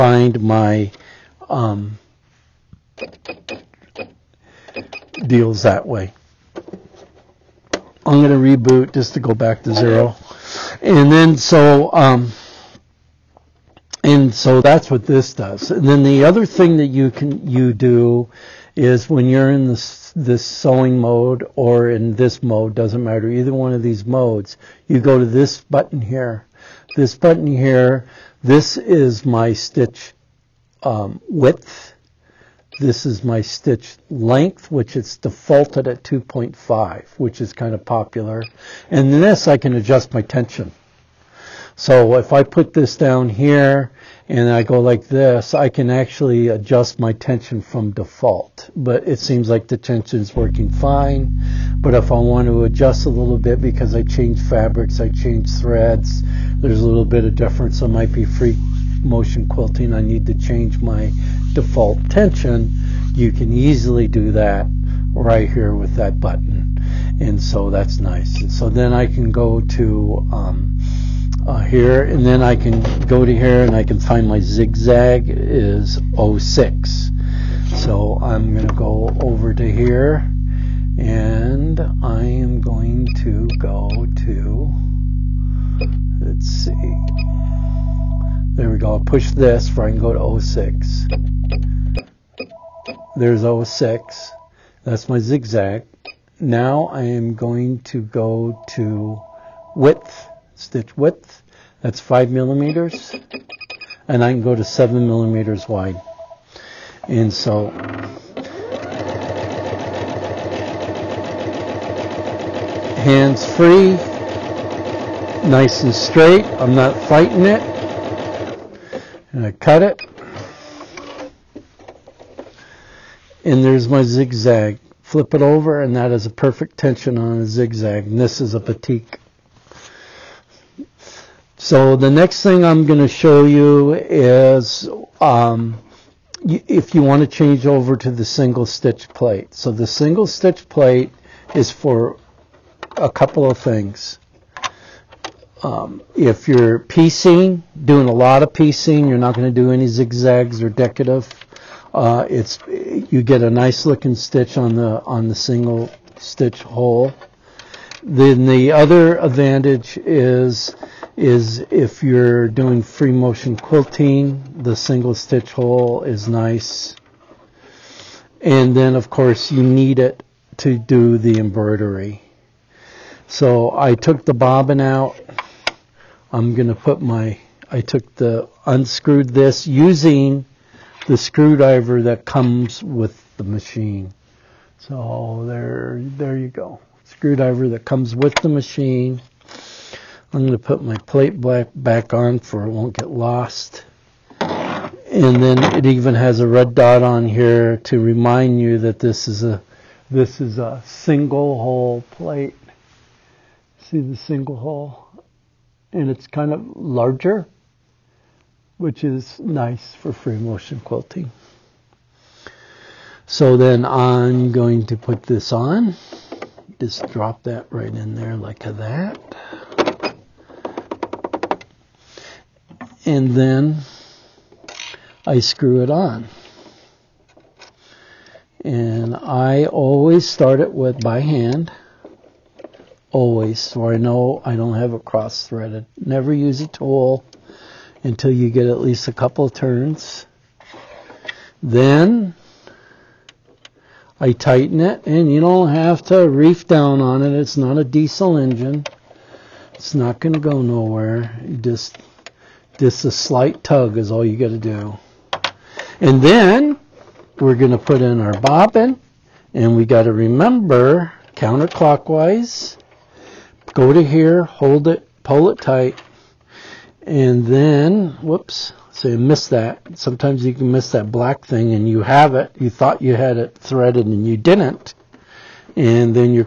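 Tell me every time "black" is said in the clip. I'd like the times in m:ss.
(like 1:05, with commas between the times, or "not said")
3:11, 4:31.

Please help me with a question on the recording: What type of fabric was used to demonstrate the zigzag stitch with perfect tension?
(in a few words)
batik.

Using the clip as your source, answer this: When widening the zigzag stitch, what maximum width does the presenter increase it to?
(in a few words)
7 millimeters.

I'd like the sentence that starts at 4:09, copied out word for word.
It's not going to go nowhere.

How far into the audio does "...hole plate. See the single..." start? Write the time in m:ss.
3:21.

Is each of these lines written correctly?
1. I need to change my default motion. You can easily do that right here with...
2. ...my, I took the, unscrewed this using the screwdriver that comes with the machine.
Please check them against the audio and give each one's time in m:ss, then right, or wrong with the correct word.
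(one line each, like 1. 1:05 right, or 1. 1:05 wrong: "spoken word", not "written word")
1. 0:59 wrong: "tension", not "motion"
2. 2:57 right.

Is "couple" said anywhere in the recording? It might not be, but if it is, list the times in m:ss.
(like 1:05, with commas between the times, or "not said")
2:23, 3:59.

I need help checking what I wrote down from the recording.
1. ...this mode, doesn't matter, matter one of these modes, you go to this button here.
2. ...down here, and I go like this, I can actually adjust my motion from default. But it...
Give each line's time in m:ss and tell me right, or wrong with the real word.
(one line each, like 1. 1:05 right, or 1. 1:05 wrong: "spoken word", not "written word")
1. 0:22 wrong: "either", not "matter"
2. 0:42 wrong: "tension", not "motion".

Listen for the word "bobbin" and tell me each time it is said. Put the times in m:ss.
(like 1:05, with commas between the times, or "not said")
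2:54, 4:18.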